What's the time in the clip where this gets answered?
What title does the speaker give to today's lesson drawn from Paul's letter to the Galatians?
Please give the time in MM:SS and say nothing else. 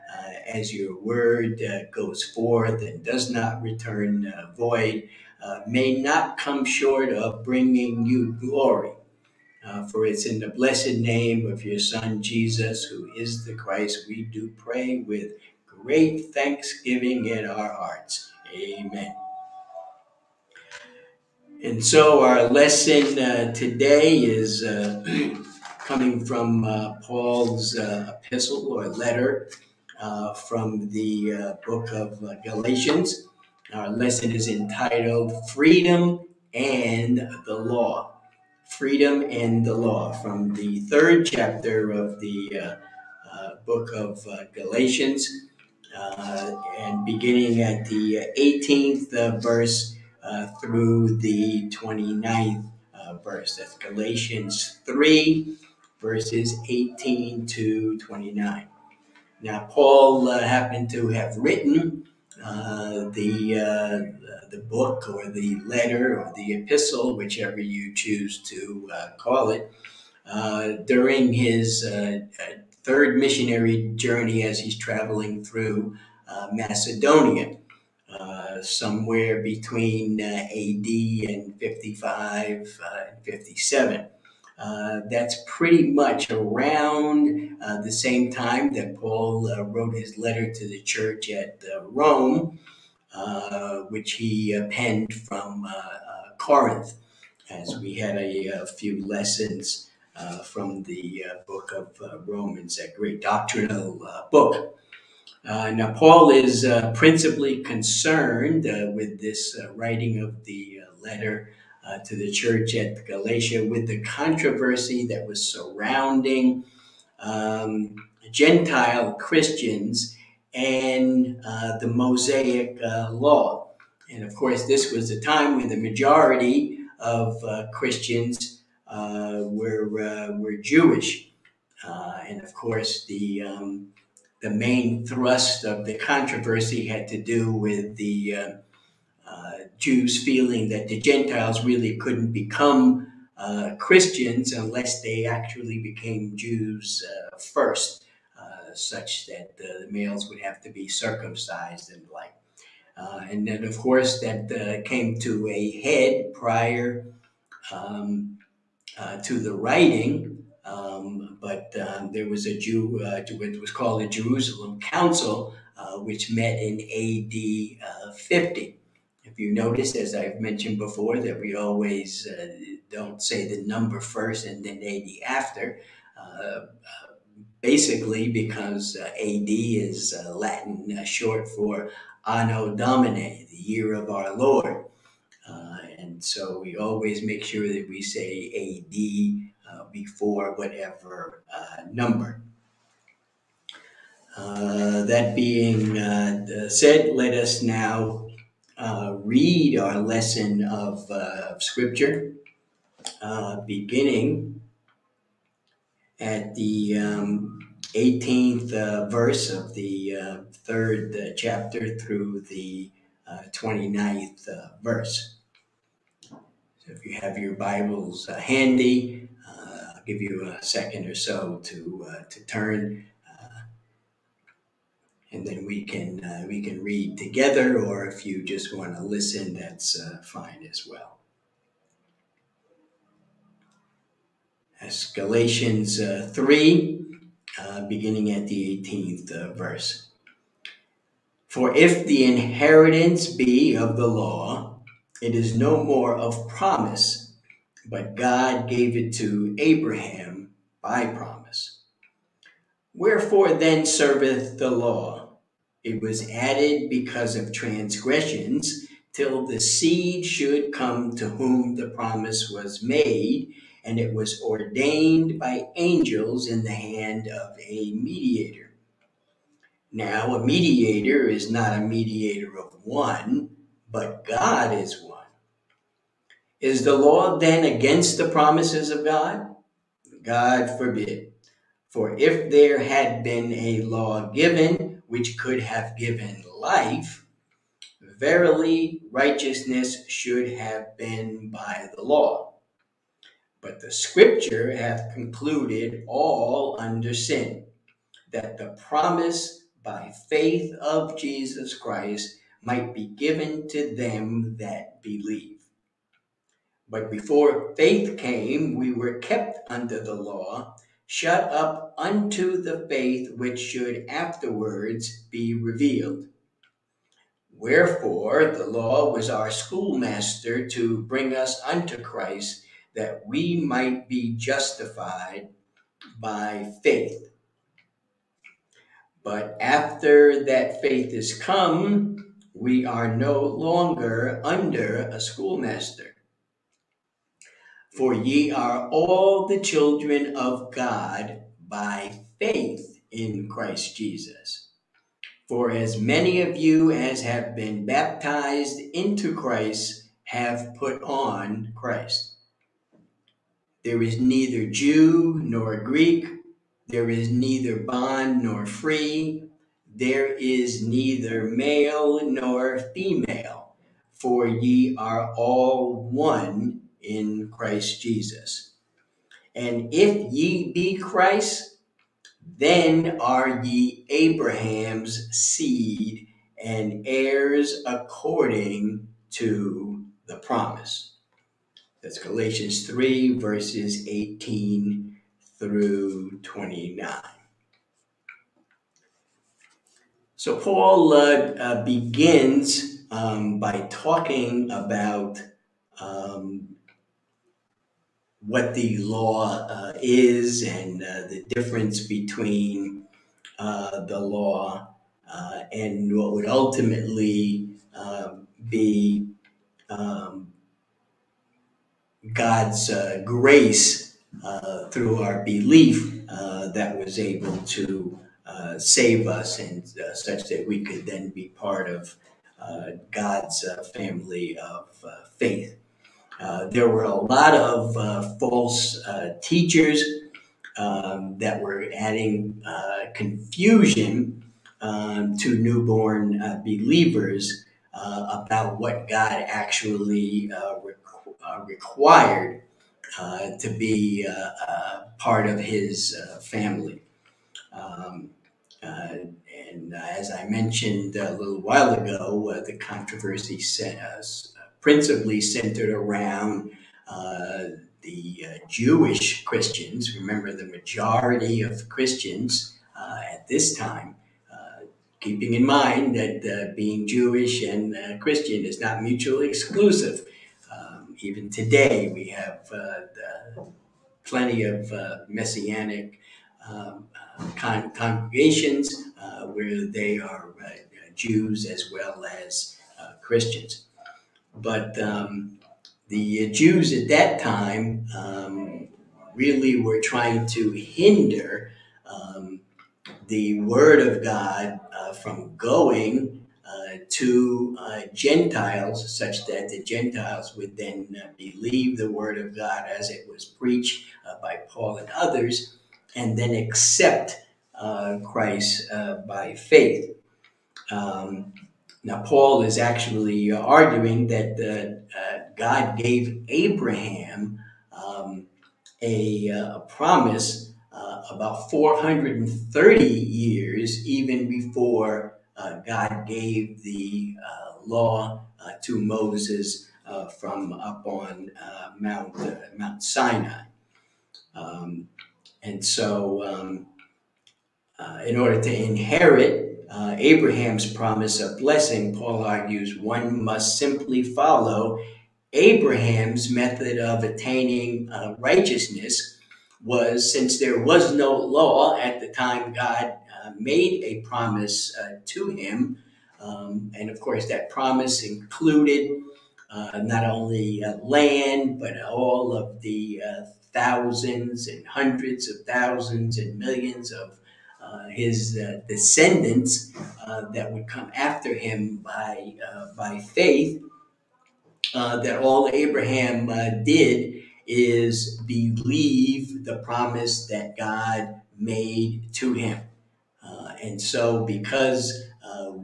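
00:35.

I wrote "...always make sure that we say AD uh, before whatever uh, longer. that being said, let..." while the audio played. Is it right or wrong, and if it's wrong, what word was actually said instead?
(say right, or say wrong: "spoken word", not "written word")
wrong: "number", not "longer".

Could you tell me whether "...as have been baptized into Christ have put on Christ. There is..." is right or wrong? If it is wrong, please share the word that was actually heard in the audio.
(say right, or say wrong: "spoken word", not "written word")
right.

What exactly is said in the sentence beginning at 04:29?
Now, a mediator is not a mediator of one, but God is one.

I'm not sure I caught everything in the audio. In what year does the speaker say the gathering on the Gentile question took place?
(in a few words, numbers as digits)
AD 50.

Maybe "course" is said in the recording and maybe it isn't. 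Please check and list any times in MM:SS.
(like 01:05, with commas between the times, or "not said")
02:04, 02:12, 02:33, 09:17.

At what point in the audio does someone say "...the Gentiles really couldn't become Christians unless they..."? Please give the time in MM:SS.
02:20.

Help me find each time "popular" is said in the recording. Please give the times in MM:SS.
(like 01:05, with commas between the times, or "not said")
not said.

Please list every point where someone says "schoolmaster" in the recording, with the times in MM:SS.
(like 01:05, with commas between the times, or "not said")
05:19, 05:35.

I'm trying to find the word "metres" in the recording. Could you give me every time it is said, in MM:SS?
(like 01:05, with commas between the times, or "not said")
not said.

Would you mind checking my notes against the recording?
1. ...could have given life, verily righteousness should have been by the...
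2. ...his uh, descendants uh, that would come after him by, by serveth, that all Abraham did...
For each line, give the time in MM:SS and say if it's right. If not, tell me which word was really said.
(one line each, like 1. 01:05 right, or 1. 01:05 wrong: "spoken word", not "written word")
1. 04:45 right
2. 09:28 wrong: "faith", not "serveth".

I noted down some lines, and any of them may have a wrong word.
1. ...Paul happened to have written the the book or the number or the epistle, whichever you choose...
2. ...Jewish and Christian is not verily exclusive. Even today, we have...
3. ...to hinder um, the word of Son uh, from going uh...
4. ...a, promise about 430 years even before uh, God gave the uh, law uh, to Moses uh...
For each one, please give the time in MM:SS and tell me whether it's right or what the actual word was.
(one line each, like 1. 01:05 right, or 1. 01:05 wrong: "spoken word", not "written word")
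1. 00:59 wrong: "letter", not "number"
2. 07:47 wrong: "mutually", not "verily"
3. 08:10 wrong: "God", not "Son"
4. 08:39 right.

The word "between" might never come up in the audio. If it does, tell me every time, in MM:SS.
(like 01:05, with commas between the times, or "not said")
01:19, 06:42.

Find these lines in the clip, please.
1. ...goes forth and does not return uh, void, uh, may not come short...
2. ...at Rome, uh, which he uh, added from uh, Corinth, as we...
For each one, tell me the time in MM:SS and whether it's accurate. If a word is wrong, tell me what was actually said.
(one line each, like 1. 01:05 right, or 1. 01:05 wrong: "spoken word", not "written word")
1. 00:01 right
2. 01:31 wrong: "penned", not "added".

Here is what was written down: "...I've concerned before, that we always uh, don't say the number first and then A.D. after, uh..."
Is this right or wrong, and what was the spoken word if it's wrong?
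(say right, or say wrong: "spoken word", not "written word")
wrong: "mentioned", not "concerned".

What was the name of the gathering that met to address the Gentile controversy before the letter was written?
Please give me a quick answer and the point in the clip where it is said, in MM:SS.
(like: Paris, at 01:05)
Jerusalem Council, at 02:44.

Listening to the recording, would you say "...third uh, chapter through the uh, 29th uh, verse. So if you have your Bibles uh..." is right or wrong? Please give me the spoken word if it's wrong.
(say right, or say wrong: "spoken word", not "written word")
right.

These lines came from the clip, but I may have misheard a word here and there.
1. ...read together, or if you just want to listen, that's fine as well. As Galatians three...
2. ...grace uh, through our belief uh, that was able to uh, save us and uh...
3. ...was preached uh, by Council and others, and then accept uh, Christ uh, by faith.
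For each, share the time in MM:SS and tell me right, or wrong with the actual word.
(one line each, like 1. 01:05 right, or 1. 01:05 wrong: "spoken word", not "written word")
1. 03:46 right
2. 06:53 right
3. 08:23 wrong: "Paul", not "Council".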